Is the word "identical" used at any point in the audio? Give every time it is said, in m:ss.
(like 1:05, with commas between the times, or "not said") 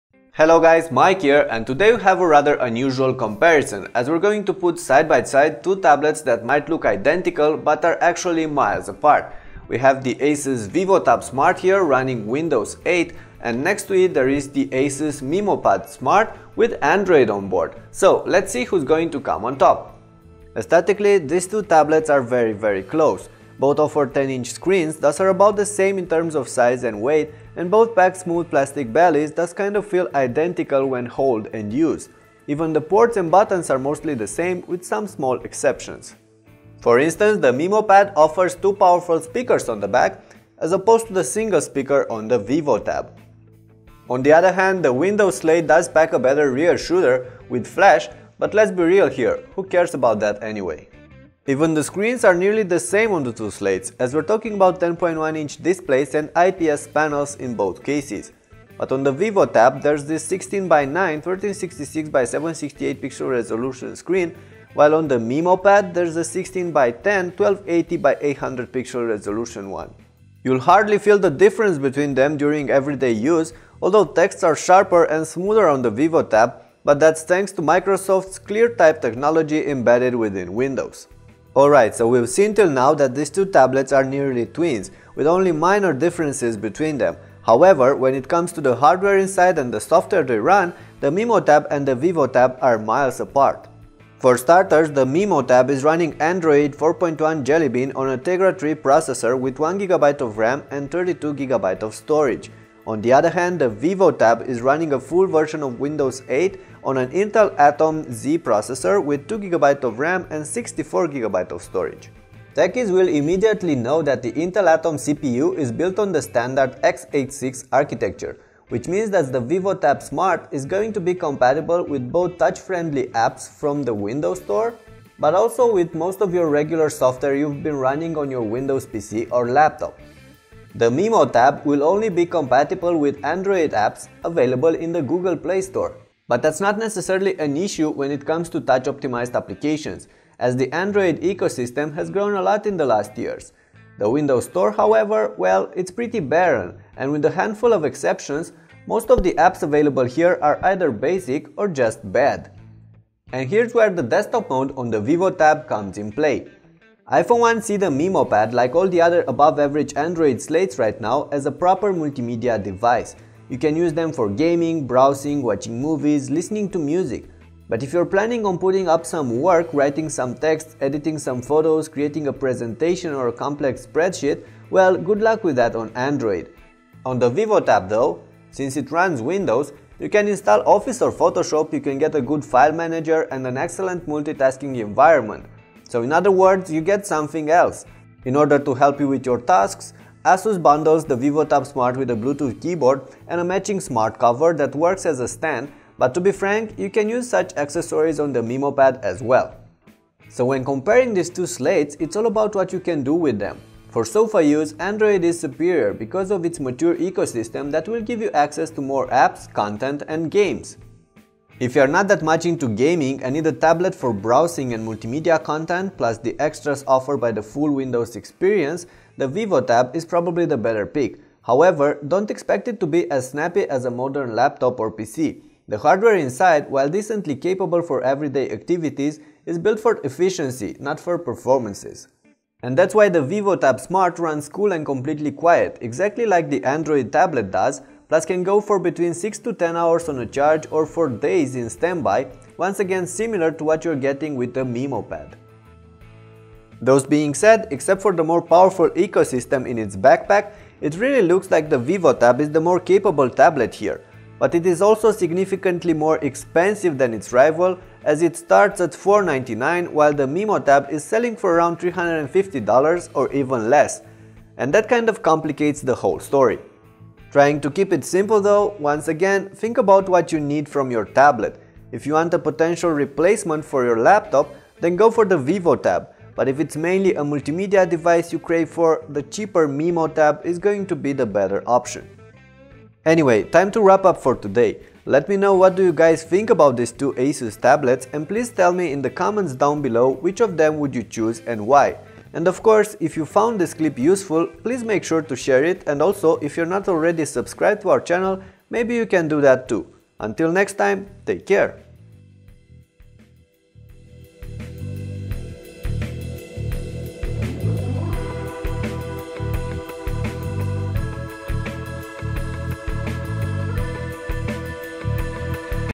0:06, 0:30.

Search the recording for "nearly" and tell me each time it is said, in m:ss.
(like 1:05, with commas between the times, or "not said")
0:52, 1:24.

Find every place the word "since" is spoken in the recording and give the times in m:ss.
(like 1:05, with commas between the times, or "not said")
2:58.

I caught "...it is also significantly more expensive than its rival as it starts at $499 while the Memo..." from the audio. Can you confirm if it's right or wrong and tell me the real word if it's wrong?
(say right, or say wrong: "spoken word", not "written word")
right.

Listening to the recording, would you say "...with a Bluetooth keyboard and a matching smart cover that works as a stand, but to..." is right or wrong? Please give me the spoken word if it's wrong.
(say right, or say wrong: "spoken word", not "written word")
right.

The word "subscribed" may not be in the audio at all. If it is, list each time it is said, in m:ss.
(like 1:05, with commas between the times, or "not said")
4:57.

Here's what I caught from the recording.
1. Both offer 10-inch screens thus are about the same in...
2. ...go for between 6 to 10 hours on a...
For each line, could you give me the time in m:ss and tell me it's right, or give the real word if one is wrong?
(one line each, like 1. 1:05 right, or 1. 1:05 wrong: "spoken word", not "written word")
1. 0:23 right
2. 3:58 right.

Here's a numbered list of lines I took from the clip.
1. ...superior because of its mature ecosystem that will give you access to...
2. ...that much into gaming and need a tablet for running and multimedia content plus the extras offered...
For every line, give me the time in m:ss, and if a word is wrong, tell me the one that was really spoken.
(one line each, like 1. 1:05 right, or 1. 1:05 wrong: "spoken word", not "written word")
1. 3:25 right
2. 3:32 wrong: "browsing", not "running".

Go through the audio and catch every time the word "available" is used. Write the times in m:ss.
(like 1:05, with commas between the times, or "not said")
2:14, 2:29.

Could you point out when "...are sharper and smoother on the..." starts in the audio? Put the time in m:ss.
1:14.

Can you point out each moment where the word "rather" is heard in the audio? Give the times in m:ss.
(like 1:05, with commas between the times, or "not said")
0:02.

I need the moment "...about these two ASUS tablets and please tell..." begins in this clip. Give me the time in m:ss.
4:46.